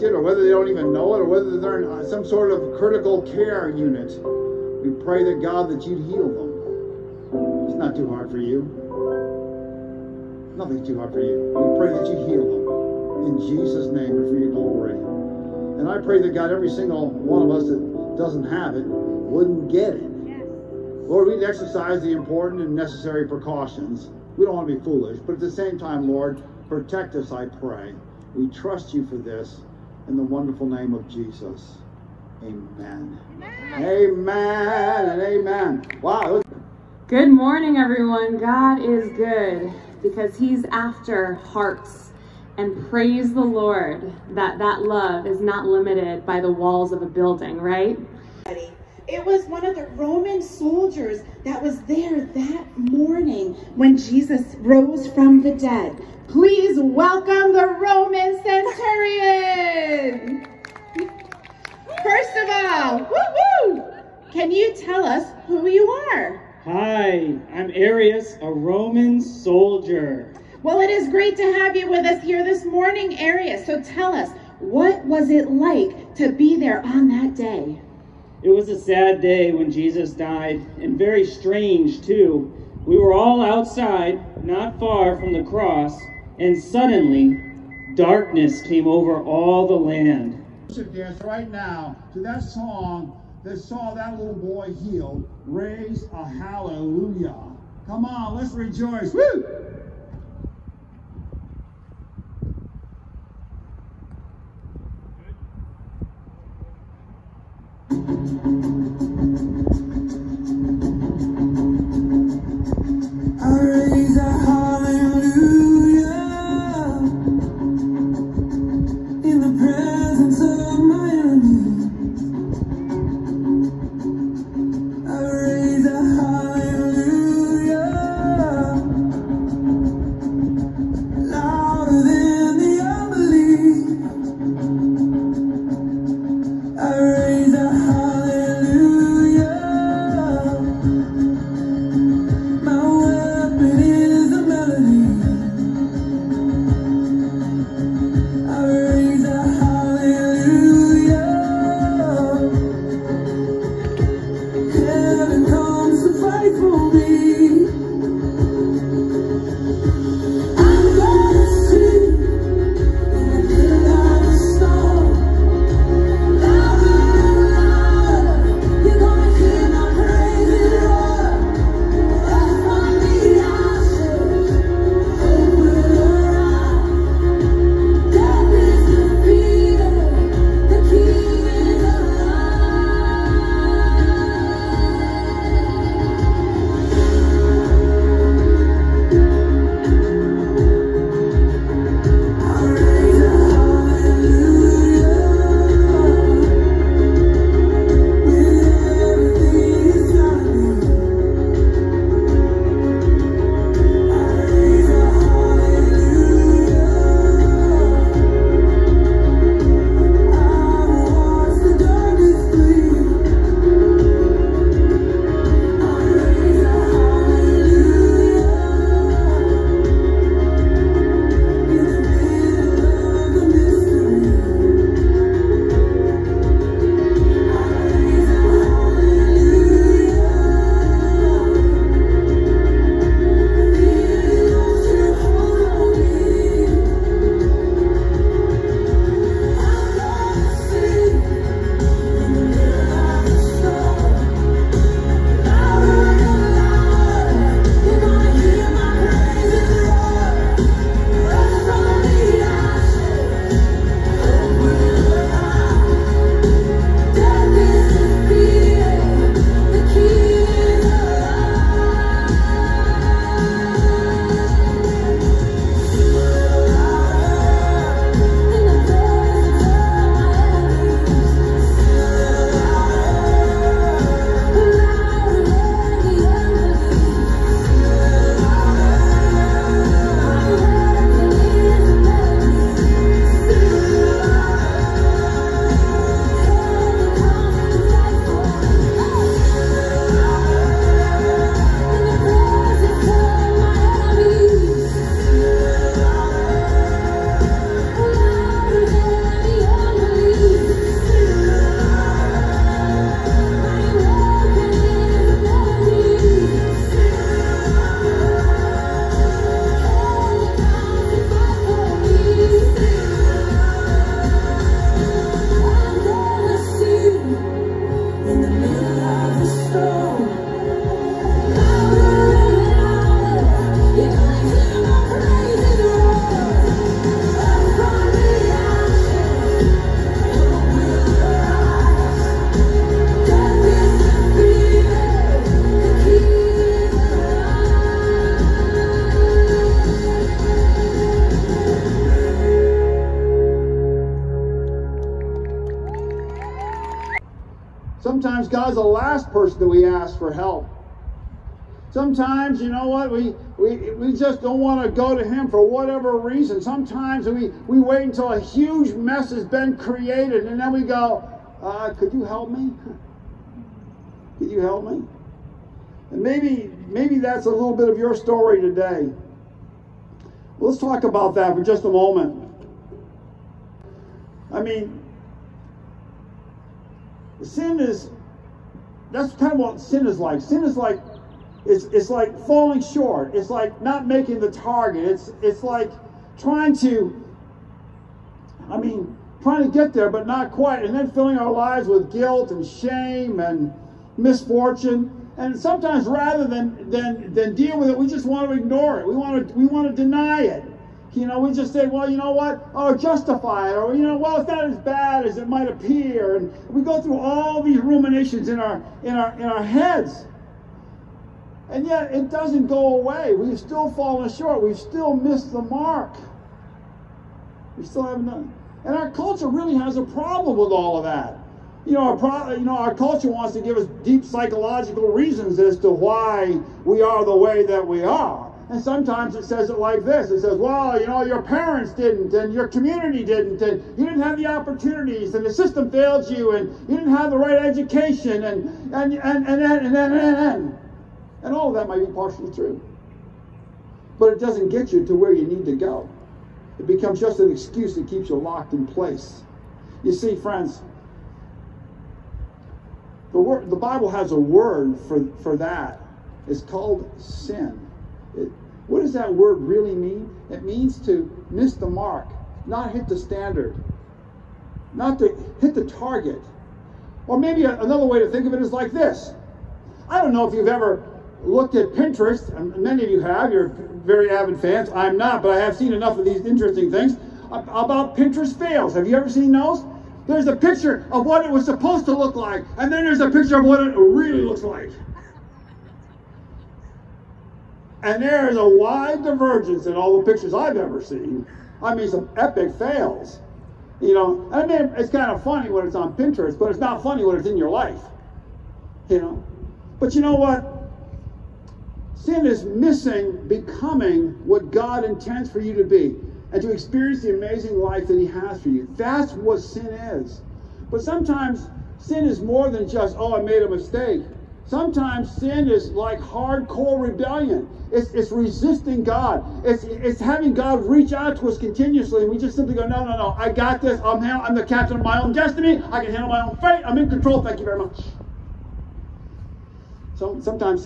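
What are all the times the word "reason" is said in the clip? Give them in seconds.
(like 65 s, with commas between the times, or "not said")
356 s, 425 s.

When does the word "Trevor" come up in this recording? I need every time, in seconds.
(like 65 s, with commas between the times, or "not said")
not said.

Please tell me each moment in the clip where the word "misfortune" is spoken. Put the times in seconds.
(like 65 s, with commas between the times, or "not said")
394 s.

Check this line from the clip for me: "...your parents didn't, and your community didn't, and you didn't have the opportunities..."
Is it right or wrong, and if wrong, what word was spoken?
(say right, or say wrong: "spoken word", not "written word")
right.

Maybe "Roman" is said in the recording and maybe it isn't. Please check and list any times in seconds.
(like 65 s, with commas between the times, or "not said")
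49 s, 57 s, 68 s.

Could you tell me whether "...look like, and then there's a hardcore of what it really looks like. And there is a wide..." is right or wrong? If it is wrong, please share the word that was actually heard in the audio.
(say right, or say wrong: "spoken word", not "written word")
wrong: "picture", not "hardcore".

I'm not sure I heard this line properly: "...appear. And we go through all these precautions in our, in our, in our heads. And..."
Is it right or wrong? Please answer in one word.
wrong.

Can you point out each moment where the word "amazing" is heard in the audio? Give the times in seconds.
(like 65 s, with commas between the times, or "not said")
507 s.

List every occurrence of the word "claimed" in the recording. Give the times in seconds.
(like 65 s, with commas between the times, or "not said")
not said.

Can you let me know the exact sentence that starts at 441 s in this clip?
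And all of that might be partially true.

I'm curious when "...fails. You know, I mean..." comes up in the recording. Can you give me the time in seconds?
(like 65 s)
492 s.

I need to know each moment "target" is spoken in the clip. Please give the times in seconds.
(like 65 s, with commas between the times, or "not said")
384 s, 465 s.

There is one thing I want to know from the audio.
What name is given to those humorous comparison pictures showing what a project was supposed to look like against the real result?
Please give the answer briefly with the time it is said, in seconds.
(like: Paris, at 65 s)
Pinterest fails, at 478 s.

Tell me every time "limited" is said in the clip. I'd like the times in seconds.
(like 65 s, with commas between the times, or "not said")
45 s.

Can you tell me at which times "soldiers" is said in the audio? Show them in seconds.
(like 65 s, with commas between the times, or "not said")
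50 s, 69 s.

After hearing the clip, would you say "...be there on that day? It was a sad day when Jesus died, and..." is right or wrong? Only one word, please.
right.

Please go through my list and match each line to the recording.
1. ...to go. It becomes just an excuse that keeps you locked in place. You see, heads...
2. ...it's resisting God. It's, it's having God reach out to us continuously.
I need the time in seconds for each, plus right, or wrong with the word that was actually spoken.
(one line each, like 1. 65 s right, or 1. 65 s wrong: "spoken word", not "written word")
1. 445 s wrong: "friends", not "heads"
2. 518 s right.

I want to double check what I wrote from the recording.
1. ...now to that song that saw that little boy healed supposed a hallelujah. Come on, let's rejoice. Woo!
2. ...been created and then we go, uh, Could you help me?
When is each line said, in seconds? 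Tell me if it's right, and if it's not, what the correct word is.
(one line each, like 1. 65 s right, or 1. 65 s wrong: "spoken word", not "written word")
1. 91 s wrong: "raised", not "supposed"
2. 359 s right.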